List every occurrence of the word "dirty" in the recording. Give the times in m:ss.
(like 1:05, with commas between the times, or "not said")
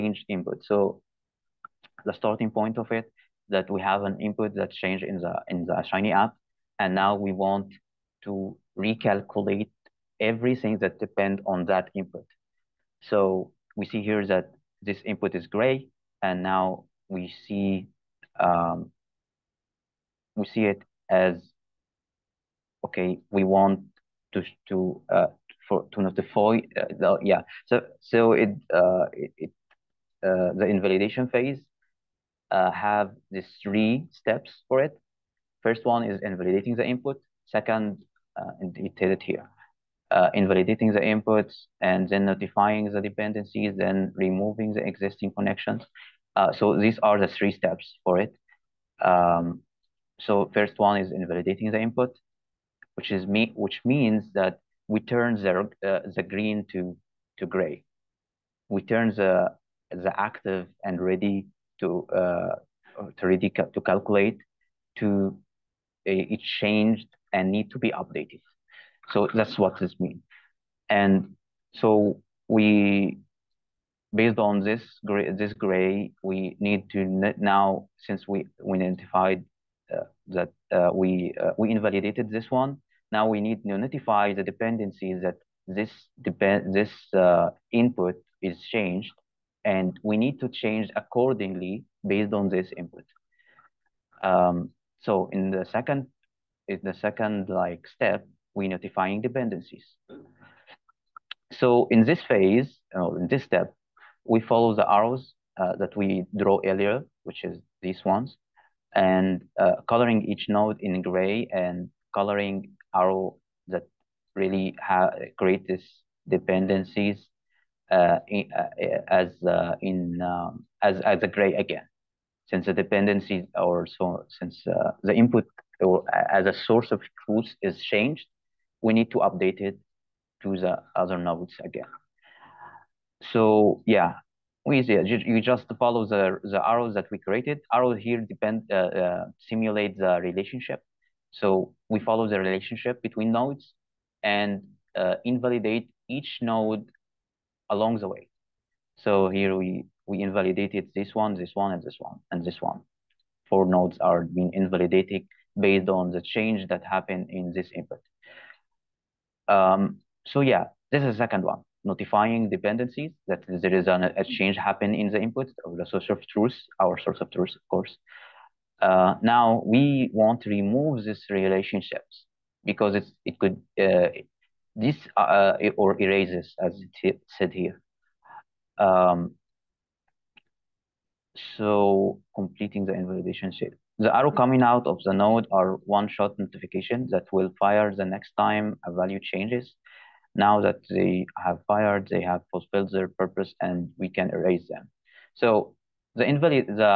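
not said.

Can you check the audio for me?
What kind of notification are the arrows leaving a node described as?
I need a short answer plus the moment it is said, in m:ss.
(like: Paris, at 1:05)
One-shot notification, at 3:05.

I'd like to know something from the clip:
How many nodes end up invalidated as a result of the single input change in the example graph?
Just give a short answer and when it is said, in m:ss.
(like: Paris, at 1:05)
4, at 2:33.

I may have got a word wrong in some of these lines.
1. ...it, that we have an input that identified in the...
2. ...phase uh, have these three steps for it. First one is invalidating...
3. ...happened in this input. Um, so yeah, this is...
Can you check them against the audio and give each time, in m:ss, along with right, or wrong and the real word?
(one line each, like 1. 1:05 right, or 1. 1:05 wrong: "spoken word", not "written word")
1. 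0:02 wrong: "changed", not "identified"
2. 0:31 right
3. 2:36 right.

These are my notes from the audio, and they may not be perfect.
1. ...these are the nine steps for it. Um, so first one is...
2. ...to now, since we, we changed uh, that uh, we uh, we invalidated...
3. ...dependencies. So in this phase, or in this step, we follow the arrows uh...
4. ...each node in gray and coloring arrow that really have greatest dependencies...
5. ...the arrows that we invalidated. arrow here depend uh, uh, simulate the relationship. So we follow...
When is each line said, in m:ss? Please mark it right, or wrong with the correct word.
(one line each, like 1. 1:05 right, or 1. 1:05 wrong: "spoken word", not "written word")
1. 0:46 wrong: "three", not "nine"
2. 1:16 wrong: "identified", not "changed"
3. 1:39 right
4. 1:50 right
5. 2:16 wrong: "created", not "invalidated".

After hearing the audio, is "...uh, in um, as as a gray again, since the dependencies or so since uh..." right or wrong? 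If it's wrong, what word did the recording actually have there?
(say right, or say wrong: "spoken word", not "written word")
right.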